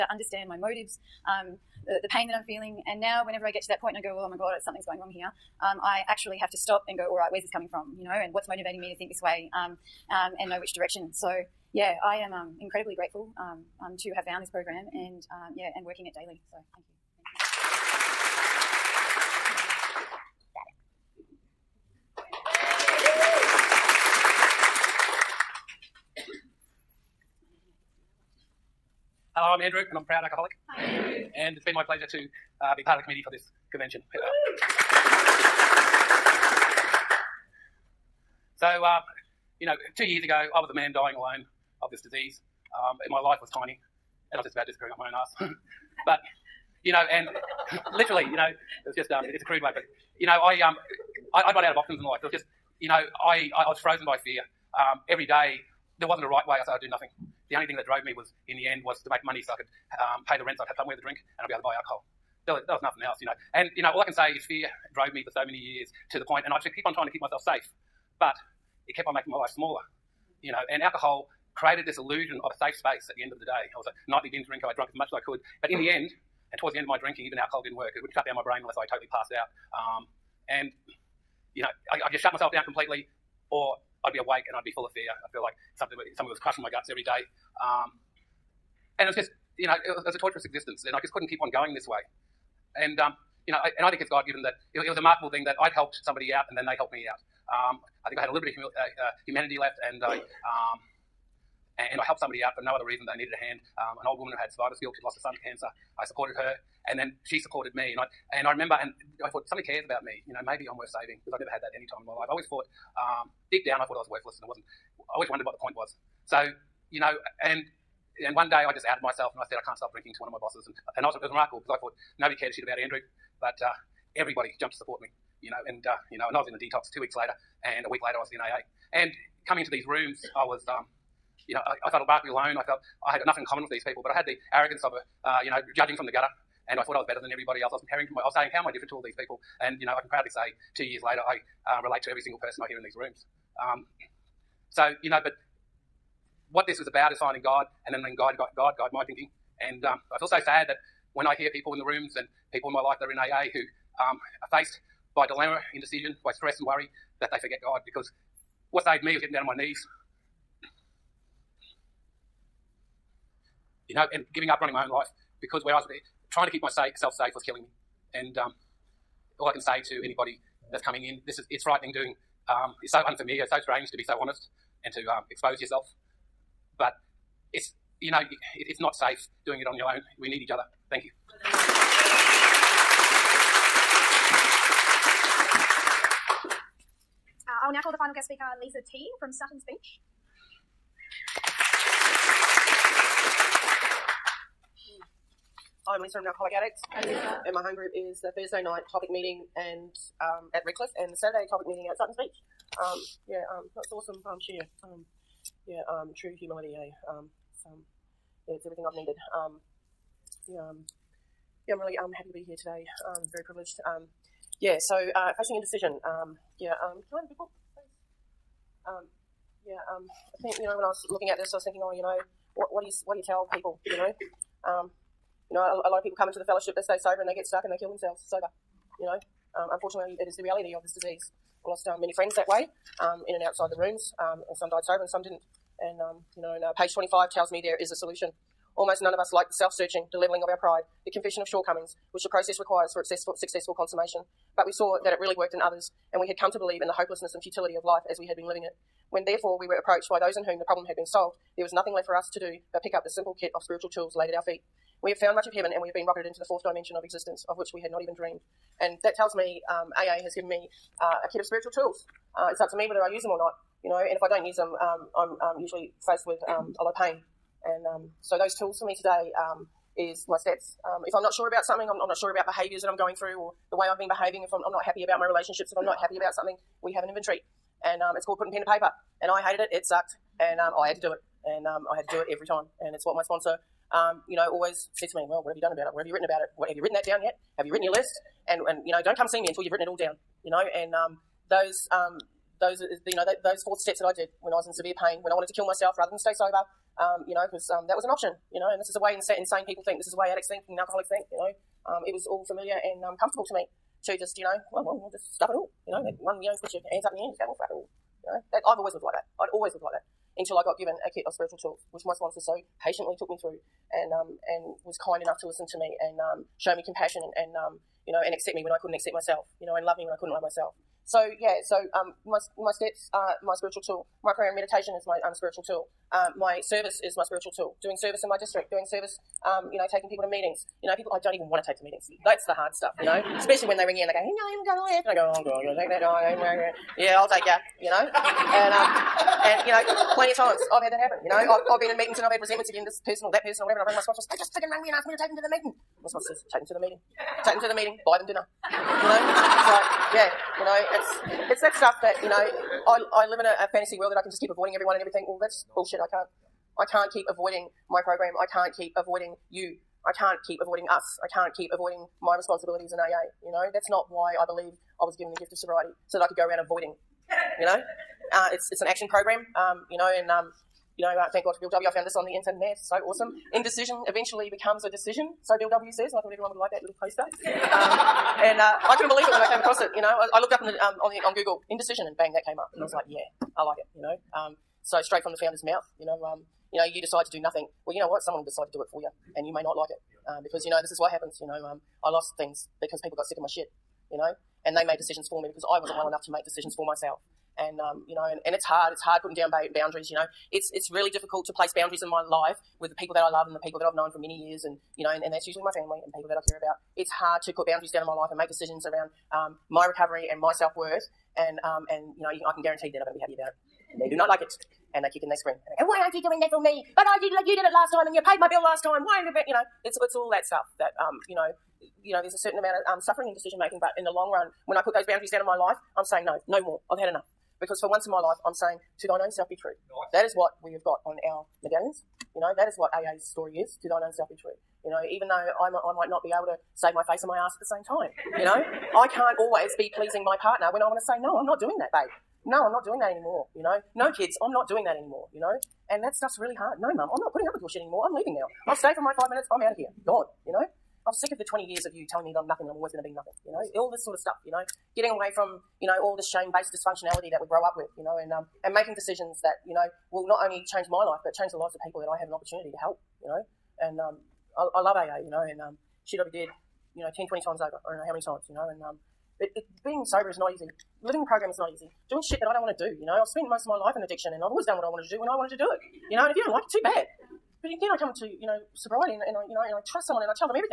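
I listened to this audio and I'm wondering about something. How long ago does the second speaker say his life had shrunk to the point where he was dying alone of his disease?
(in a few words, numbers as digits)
2 years.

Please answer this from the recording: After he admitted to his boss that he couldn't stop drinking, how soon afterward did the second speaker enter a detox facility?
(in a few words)
2 weeks.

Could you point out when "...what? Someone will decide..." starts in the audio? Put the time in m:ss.
6:28.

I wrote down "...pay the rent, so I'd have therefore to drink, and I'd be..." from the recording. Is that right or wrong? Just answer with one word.
wrong.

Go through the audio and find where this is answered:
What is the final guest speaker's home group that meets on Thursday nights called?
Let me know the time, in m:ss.
3:18.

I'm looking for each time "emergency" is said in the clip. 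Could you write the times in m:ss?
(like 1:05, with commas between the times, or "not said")
not said.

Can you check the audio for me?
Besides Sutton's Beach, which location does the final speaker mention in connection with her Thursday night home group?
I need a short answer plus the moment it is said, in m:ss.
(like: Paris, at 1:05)
Redcliffe, at 3:20.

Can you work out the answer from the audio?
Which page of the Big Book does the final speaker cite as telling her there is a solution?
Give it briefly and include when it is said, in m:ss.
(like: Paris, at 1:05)
25, at 3:56.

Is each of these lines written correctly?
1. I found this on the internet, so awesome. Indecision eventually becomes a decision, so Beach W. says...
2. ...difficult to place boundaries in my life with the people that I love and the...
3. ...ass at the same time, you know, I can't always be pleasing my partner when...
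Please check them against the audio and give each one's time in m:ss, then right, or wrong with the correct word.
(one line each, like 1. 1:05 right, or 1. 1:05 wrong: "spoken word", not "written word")
1. 6:11 wrong: "Bill", not "Beach"
2. 6:41 right
3. 7:17 right.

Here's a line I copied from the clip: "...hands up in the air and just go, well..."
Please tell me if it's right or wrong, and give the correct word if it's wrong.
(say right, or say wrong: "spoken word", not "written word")
right.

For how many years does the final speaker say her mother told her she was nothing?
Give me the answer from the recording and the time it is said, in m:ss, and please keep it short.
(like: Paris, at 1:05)
20 years, at 7:31.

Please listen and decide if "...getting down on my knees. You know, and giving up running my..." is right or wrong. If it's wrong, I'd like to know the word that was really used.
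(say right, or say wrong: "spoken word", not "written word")
right.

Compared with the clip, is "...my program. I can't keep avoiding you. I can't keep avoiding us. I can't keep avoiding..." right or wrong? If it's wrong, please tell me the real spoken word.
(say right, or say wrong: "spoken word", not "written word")
right.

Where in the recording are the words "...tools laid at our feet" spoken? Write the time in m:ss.
4:13.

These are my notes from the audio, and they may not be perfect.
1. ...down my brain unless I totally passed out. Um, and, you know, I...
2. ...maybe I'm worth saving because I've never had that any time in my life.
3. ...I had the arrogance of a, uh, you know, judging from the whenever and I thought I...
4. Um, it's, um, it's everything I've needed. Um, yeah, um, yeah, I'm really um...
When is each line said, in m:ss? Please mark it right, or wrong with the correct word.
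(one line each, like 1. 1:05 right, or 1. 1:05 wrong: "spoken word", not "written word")
1. 1:18 right
2. 1:50 right
3. 2:14 wrong: "gutter", not "whenever"
4. 3:27 right.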